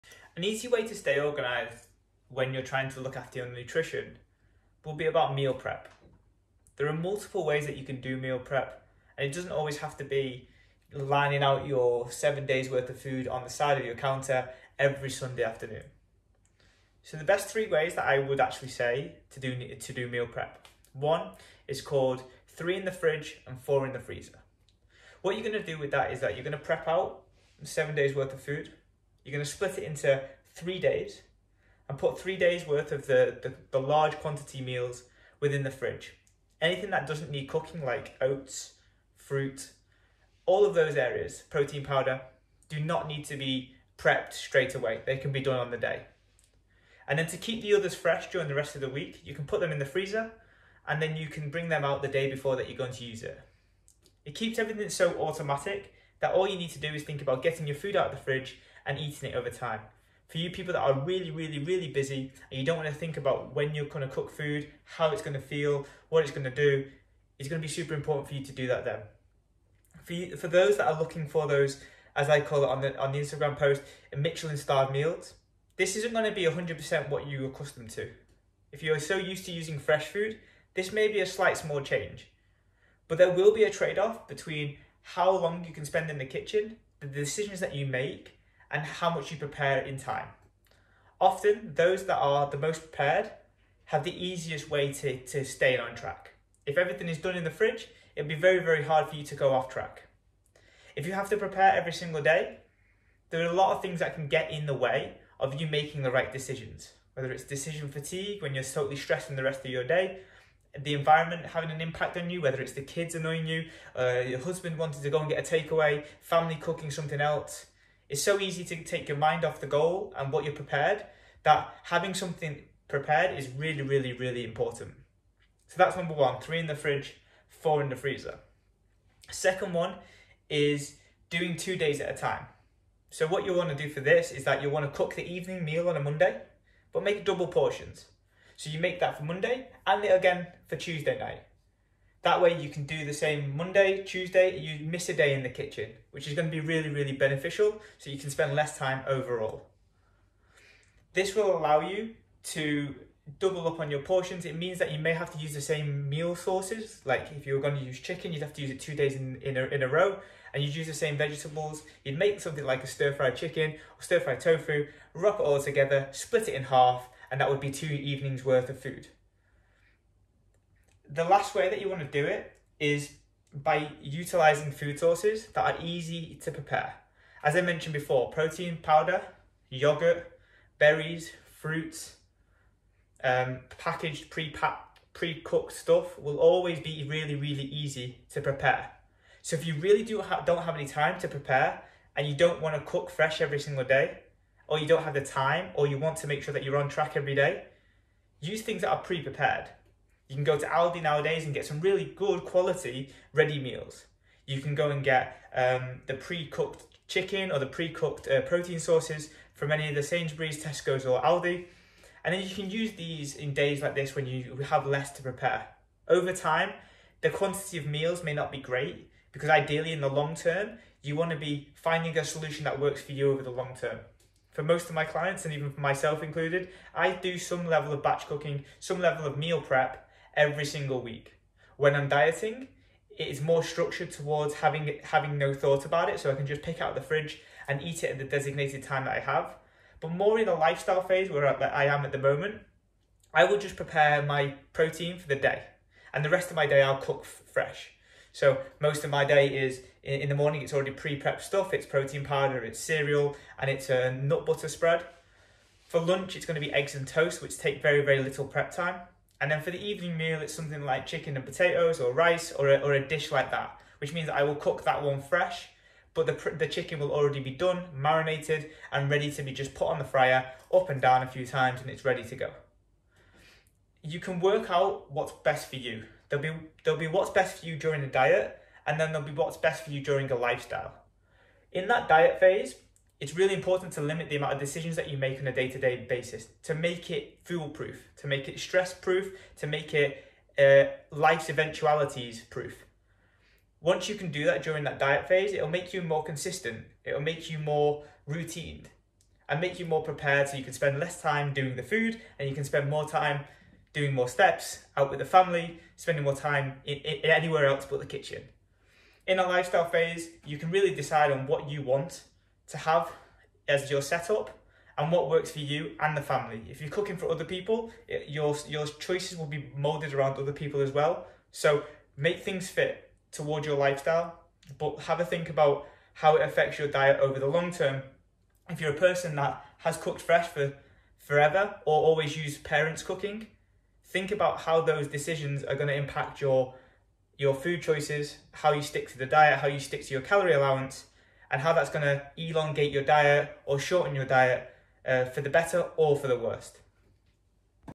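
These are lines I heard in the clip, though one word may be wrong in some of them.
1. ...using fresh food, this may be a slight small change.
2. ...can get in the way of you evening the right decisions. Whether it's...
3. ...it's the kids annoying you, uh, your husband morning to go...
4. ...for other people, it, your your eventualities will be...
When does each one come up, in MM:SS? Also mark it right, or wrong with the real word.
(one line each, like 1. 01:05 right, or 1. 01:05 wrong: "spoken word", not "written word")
1. 01:19 right
2. 01:44 wrong: "making", not "evening"
3. 01:52 wrong: "wanting", not "morning"
4. 05:17 wrong: "choices", not "eventualities".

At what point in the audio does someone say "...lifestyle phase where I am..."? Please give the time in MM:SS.
04:00.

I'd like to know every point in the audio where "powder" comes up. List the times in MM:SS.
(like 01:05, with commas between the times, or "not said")
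00:41, 02:58, 04:12.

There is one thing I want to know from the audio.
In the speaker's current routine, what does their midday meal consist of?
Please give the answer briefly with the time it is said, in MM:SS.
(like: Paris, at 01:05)
eggs and toast, at 04:16.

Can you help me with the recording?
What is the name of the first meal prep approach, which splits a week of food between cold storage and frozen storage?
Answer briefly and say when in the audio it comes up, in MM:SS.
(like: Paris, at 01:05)
three in the fridge and four in the freezer, at 00:22.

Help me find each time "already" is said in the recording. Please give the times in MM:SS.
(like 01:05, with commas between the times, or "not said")
04:10, 04:27.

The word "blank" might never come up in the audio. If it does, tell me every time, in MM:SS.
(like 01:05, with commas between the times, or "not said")
not said.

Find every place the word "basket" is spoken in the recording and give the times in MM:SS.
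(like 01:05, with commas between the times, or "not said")
not said.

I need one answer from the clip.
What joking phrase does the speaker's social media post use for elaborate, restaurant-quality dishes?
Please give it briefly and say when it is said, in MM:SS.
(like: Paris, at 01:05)
Michelin starred meals, at 01:14.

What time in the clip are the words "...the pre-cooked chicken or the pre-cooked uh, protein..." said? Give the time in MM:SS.
03:26.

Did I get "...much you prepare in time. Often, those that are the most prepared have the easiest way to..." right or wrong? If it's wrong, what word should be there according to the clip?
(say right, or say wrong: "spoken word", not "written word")
right.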